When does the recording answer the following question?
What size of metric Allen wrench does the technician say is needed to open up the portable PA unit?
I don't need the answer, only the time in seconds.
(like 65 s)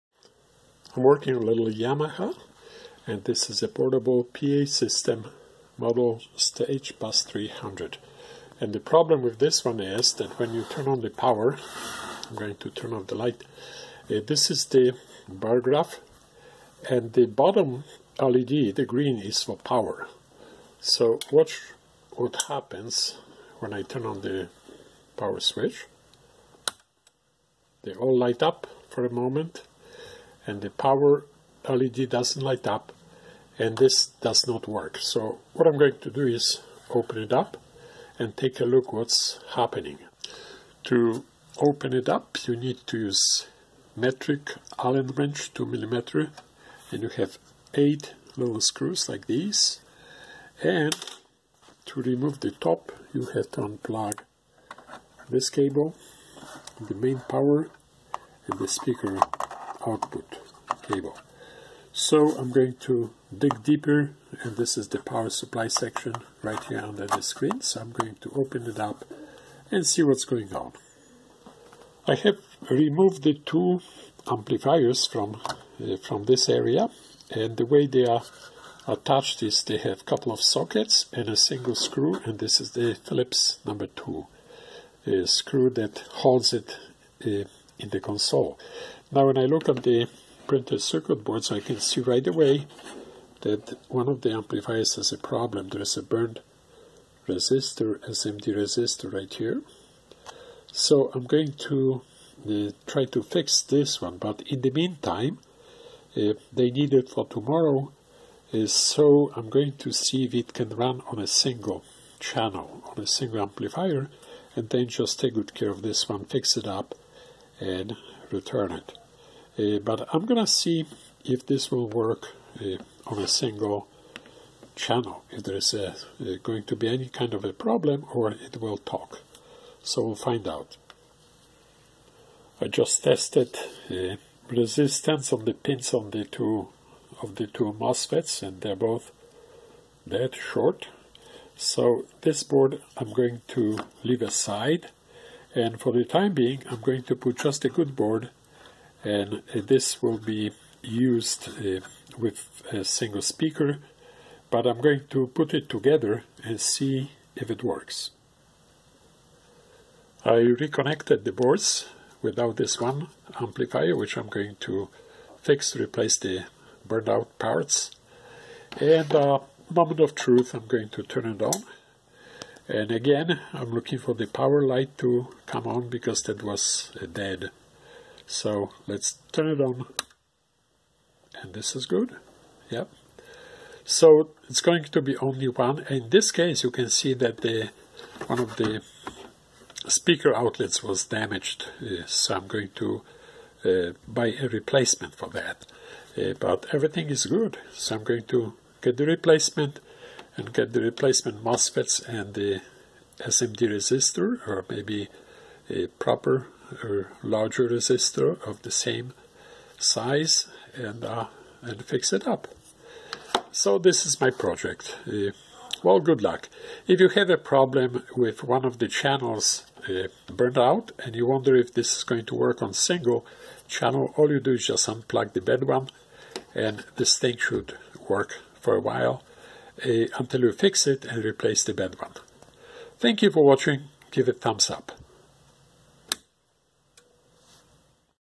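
45 s.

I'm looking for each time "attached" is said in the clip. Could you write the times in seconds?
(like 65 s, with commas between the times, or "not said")
78 s.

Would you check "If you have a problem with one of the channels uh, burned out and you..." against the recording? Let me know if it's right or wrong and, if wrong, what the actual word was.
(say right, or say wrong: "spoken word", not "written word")
right.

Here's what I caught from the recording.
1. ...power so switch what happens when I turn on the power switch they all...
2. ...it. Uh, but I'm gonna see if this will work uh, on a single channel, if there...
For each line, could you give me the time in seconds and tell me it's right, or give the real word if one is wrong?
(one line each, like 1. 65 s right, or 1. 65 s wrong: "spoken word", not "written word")
1. 19 s wrong: "watch", not "switch"
2. 118 s right.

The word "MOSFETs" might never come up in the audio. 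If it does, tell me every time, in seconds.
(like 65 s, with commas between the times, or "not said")
137 s, 201 s.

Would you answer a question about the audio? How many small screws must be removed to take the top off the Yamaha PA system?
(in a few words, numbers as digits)
8.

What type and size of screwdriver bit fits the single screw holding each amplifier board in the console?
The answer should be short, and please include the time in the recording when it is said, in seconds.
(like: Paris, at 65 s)
Phillips number 2, at 82 s.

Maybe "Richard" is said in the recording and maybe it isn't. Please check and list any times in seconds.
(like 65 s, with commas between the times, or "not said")
not said.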